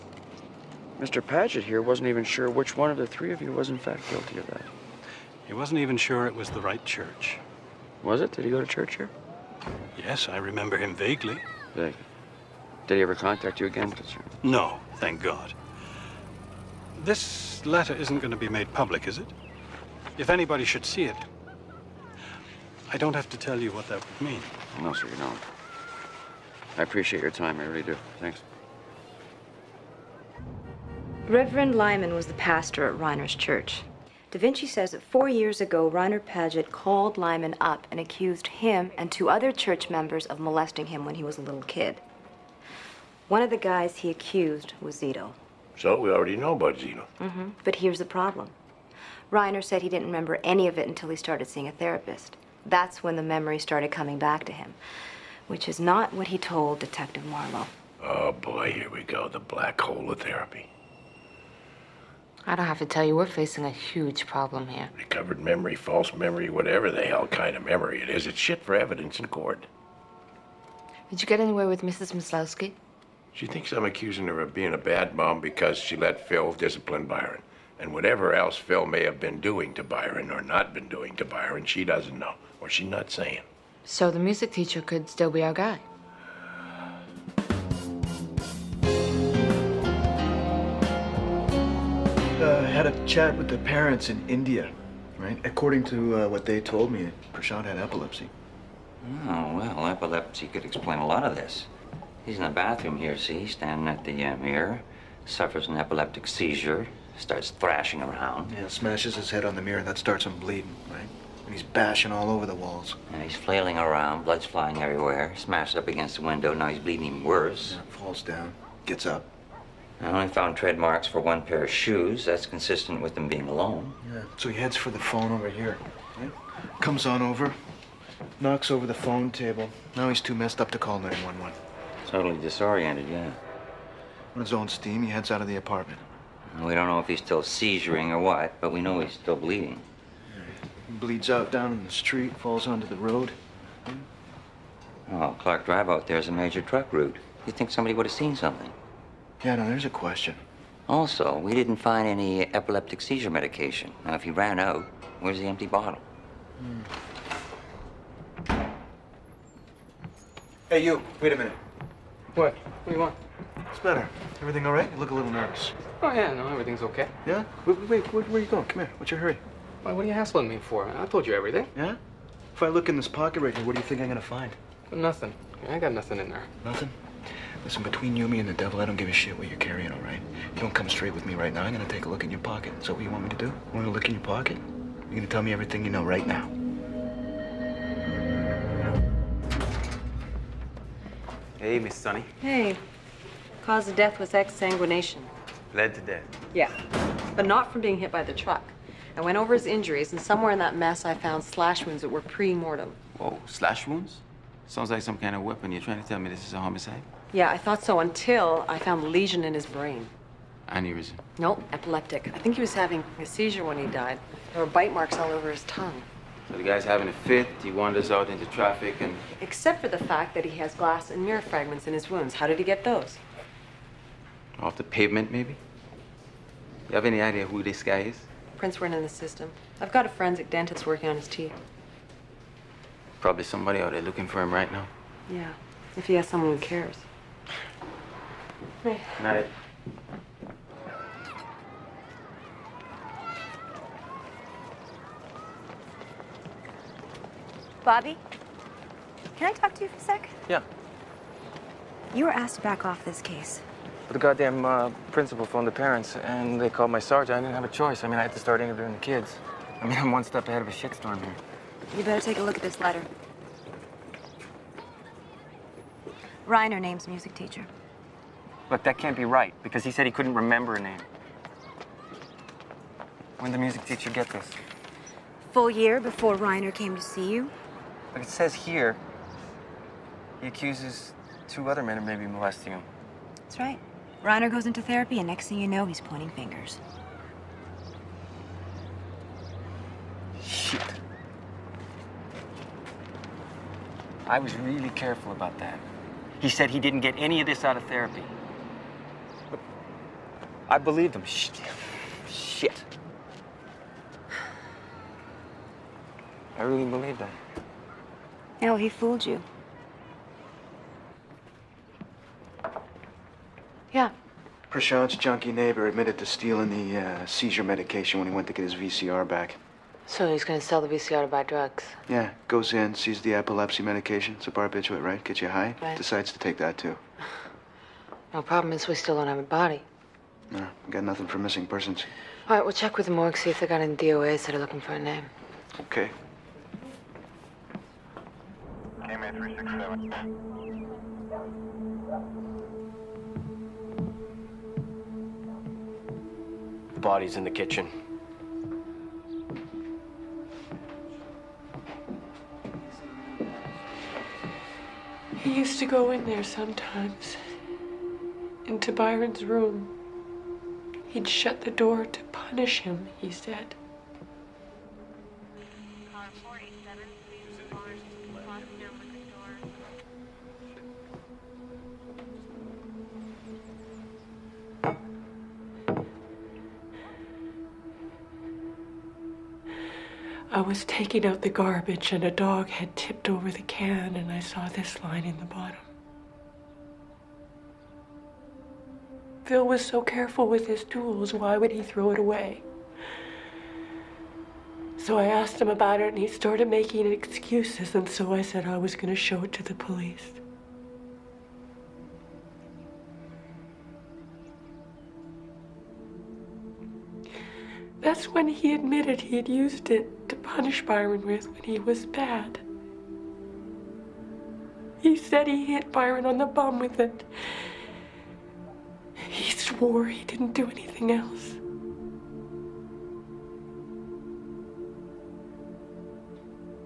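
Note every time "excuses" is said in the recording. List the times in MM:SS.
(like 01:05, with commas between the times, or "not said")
06:37.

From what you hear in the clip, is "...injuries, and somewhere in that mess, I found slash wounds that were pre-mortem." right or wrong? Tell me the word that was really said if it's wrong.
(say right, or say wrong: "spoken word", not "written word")
right.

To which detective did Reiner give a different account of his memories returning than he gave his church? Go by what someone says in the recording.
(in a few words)
Detective Marlowe.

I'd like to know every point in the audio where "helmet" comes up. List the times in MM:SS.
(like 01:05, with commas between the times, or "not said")
not said.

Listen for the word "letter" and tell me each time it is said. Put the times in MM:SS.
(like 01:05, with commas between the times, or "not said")
00:17, 04:22.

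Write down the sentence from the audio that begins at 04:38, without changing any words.
Like it says here, he accuses two other men of maybe molesting him.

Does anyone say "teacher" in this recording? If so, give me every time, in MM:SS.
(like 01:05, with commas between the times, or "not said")
01:24, 04:27, 04:33.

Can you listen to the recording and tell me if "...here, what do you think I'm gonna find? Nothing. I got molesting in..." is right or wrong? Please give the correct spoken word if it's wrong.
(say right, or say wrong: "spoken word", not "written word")
wrong: "nothing", not "molesting".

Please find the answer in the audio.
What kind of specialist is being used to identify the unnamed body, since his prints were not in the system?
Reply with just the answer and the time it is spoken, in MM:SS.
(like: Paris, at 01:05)
forensic dentist, at 03:50.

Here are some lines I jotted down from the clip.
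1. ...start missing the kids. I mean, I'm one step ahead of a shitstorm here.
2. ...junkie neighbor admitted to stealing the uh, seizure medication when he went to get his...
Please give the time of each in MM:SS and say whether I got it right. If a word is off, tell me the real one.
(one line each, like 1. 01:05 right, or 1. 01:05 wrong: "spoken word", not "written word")
1. 04:18 wrong: "interviewing", not "missing"
2. 05:15 right.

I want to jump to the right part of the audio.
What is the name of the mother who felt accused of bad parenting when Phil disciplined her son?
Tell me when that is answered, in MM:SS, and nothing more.
01:11.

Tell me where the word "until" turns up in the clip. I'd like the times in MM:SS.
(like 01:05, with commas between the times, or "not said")
00:50, 03:27.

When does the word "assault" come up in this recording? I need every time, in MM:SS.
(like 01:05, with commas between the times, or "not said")
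not said.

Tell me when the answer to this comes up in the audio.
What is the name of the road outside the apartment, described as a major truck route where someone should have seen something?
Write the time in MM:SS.
02:25.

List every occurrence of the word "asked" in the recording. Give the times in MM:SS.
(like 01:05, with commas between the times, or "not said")
04:12, 06:35.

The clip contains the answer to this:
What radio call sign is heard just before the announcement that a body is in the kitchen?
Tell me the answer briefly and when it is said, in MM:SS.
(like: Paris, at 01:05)
KMA 367, at 05:39.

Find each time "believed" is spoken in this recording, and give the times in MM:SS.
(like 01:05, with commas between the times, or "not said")
05:00, 05:06.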